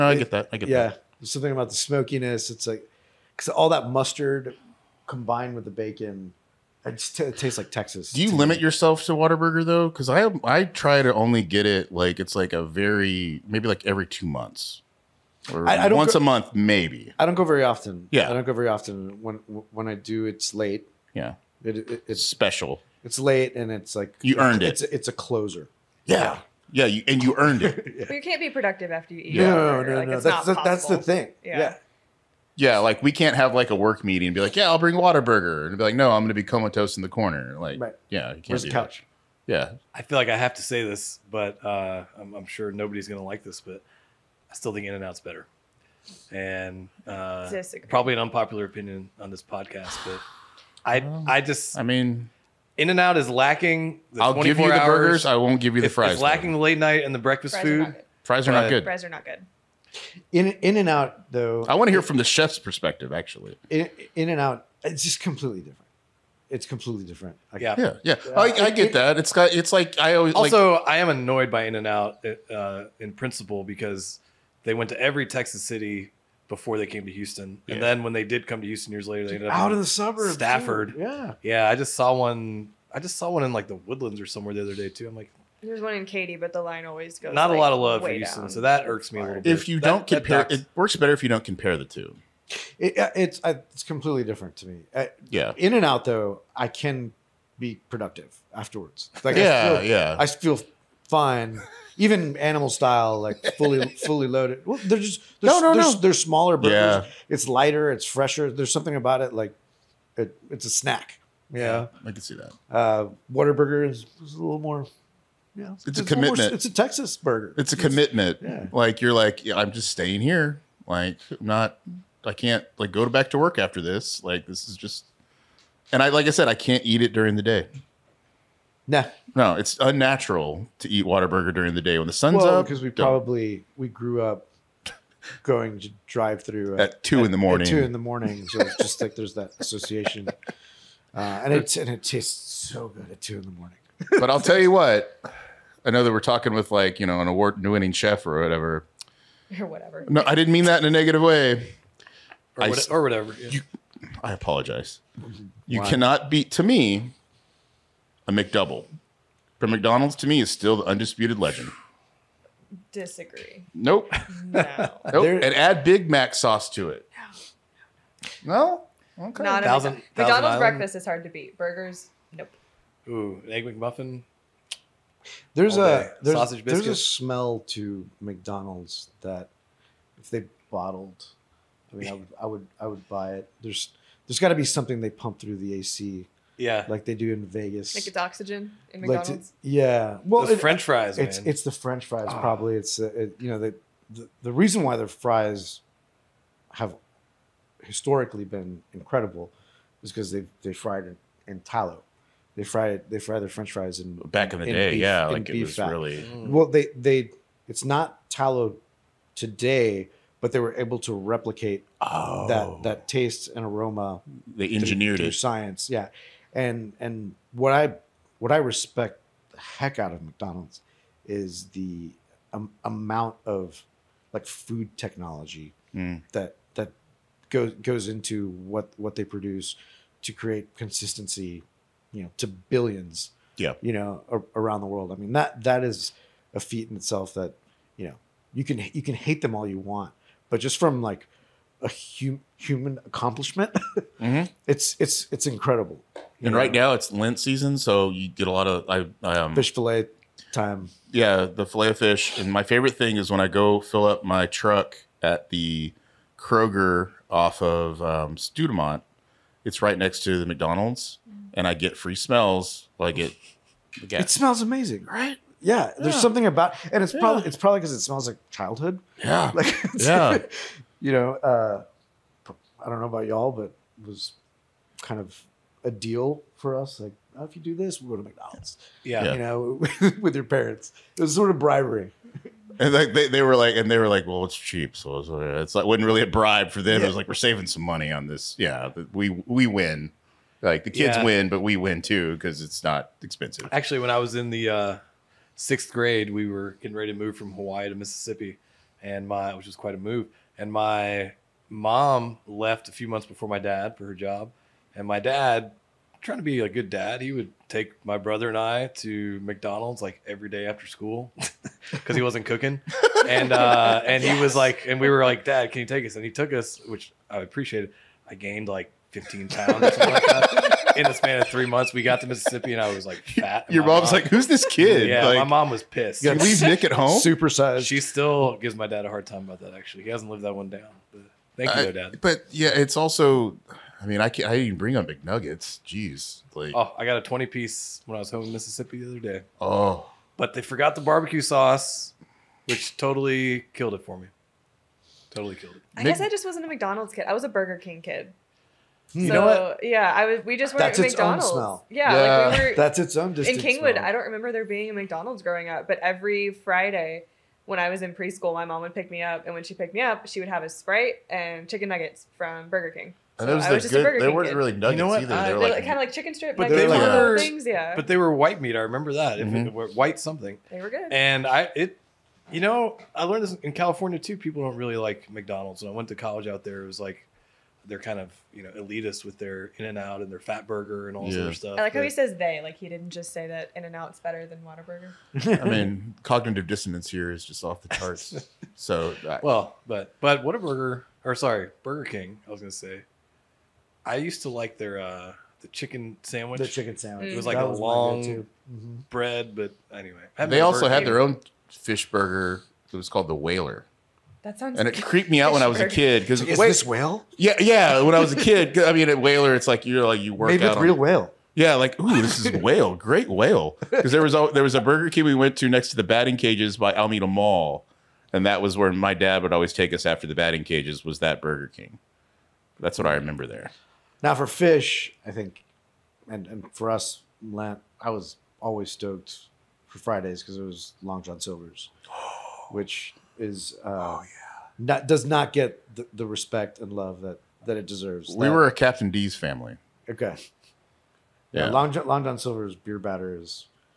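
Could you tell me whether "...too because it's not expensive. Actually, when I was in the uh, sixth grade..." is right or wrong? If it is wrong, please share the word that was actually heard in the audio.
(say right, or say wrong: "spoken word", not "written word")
right.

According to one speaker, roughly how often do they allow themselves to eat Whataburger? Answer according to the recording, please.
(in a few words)
every two months.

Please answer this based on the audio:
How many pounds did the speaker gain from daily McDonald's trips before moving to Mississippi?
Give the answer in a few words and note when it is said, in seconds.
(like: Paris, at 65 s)
15, at 319 s.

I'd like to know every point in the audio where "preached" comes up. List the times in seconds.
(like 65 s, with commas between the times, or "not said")
not said.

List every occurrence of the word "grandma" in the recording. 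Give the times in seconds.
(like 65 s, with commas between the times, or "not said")
not said.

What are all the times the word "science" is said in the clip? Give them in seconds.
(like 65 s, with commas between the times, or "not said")
215 s.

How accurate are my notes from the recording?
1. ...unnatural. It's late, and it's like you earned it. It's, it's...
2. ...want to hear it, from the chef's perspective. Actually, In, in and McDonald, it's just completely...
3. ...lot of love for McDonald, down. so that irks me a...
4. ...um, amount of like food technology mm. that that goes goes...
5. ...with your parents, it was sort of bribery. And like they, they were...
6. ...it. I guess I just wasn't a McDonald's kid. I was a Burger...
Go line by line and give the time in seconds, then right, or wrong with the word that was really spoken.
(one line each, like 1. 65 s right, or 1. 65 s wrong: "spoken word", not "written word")
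1. 22 s wrong: "special", not "unnatural"
2. 61 s wrong: "Out", not "McDonald"
3. 87 s wrong: "Houston", not "McDonald"
4. 222 s right
5. 280 s right
6. 345 s right.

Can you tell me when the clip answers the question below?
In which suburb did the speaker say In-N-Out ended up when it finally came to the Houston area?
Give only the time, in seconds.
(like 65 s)
80 s.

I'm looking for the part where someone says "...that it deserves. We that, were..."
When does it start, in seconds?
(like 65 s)
437 s.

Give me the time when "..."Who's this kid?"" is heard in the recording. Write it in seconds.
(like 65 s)
324 s.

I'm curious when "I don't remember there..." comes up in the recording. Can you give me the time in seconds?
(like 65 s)
354 s.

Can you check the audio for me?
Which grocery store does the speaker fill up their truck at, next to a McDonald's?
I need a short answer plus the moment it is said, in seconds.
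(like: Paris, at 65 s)
Kroger, at 256 s.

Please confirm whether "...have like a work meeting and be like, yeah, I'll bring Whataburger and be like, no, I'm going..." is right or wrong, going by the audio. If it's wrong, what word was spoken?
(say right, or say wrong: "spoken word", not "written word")
right.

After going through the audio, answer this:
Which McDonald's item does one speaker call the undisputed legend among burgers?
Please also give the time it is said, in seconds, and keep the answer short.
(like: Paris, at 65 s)
McDouble, at 158 s.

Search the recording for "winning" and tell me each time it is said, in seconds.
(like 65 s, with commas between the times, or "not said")
147 s.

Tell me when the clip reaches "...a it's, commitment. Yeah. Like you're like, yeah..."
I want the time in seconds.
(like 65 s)
117 s.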